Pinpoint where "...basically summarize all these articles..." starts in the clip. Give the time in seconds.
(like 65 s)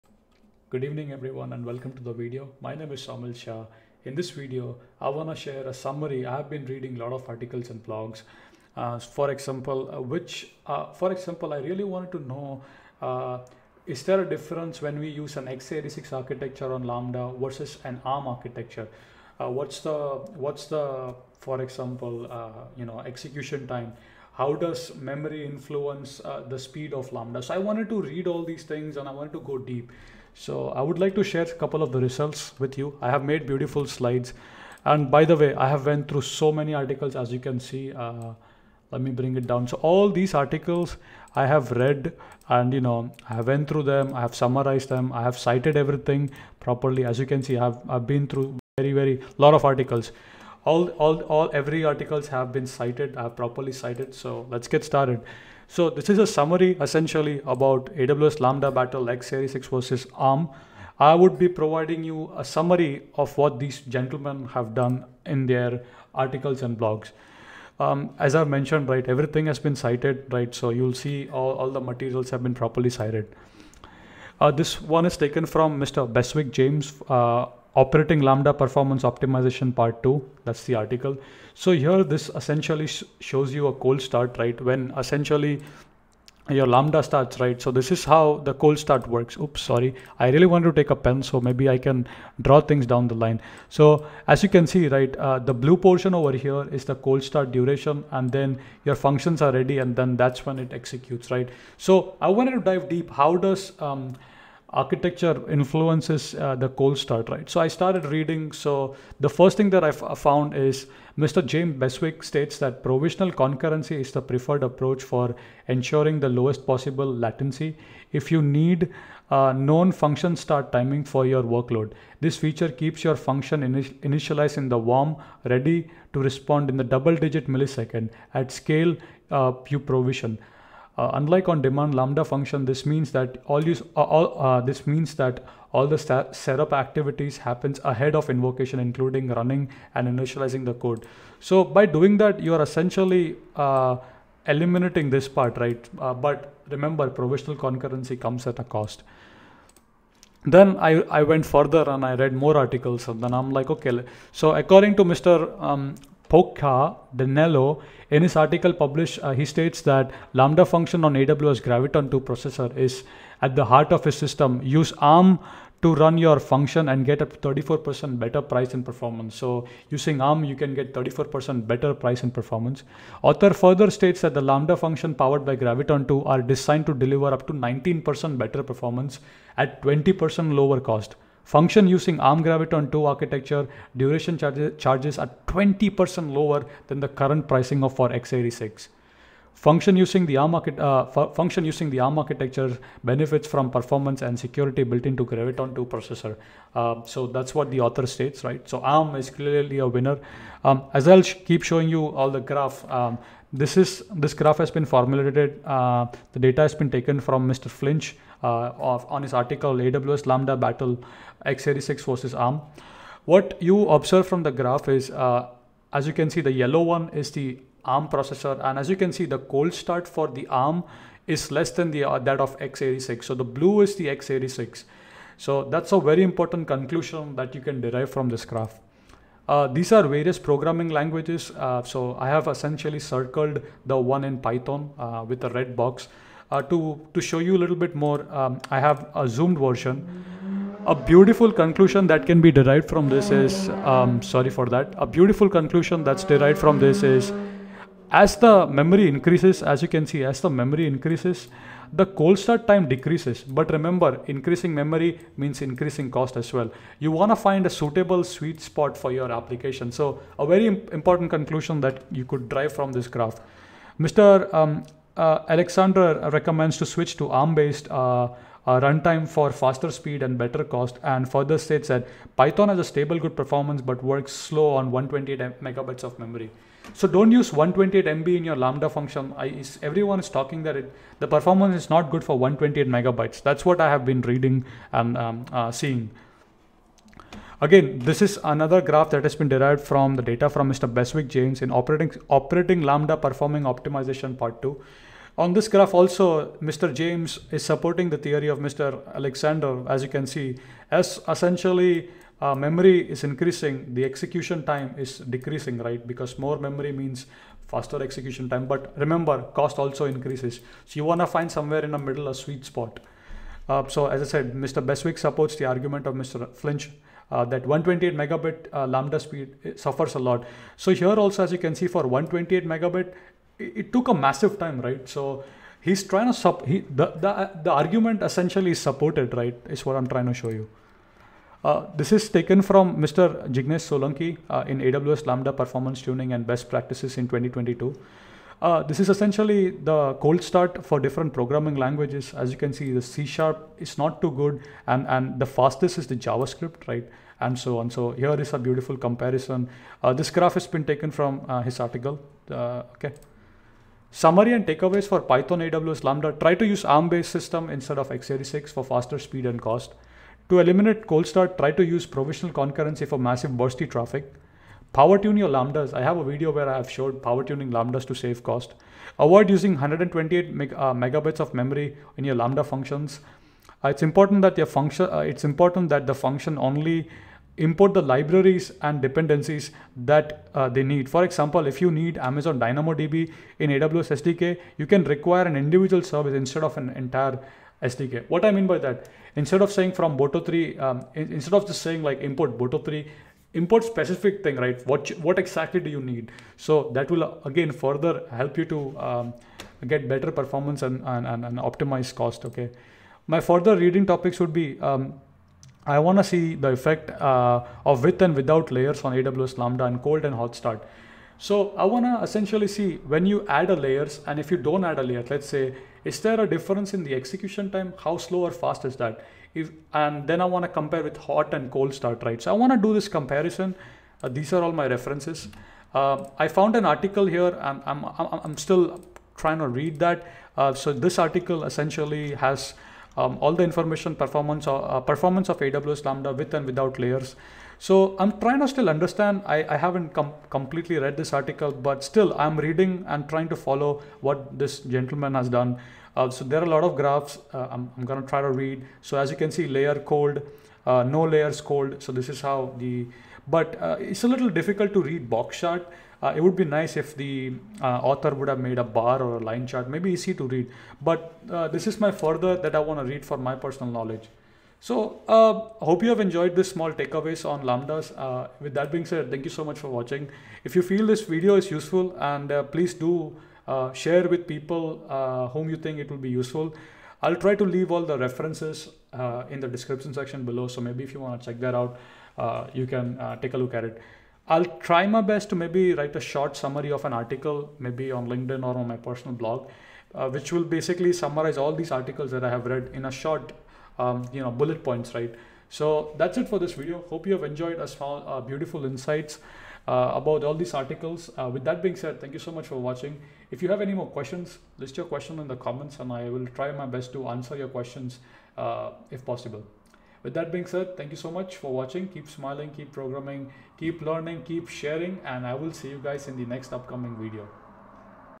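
490 s.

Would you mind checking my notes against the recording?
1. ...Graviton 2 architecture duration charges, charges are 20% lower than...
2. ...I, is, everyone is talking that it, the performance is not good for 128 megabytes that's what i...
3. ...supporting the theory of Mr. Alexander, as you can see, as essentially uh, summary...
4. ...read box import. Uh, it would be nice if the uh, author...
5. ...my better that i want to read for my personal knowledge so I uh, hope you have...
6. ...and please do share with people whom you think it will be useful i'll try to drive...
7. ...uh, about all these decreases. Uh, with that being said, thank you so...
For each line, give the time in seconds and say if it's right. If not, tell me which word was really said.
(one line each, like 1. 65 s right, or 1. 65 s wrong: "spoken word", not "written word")
1. 182 s right
2. 279 s right
3. 297 s wrong: "memory", not "summary"
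4. 455 s wrong: "chart", not "import"
5. 461 s wrong: "further", not "better"
6. 472 s wrong: "leave", not "drive"
7. 499 s wrong: "articles", not "decreases".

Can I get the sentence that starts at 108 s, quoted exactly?
So the first thing that I found is Mr.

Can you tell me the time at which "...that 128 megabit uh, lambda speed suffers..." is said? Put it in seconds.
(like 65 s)
317 s.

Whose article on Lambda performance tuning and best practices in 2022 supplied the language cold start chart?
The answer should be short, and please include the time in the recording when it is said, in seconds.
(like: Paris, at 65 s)
Jignesh Solanki, at 333 s.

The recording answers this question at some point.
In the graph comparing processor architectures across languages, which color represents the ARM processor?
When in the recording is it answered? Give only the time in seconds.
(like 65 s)
216 s.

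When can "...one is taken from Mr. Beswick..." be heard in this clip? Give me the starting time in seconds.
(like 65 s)
74 s.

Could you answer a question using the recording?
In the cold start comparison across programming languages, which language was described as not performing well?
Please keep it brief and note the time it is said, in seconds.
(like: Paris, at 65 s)
C#, at 343 s.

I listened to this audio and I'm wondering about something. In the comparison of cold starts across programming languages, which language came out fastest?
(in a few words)
JavaScript.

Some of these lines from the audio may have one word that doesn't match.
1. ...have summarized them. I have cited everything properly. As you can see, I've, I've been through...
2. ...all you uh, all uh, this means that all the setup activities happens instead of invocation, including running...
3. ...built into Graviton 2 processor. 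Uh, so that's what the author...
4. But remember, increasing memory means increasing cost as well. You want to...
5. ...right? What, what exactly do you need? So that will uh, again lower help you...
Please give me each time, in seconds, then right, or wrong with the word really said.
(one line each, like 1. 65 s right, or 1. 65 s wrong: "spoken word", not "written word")
1. 44 s right
2. 133 s wrong: "ahead", not "instead"
3. 194 s right
4. 253 s right
5. 394 s wrong: "further", not "lower".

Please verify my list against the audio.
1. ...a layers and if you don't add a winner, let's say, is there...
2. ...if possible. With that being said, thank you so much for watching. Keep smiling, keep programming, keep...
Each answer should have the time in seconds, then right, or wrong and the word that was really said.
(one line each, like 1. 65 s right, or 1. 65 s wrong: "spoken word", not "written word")
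1. 413 s wrong: "layer", not "winner"
2. 509 s right.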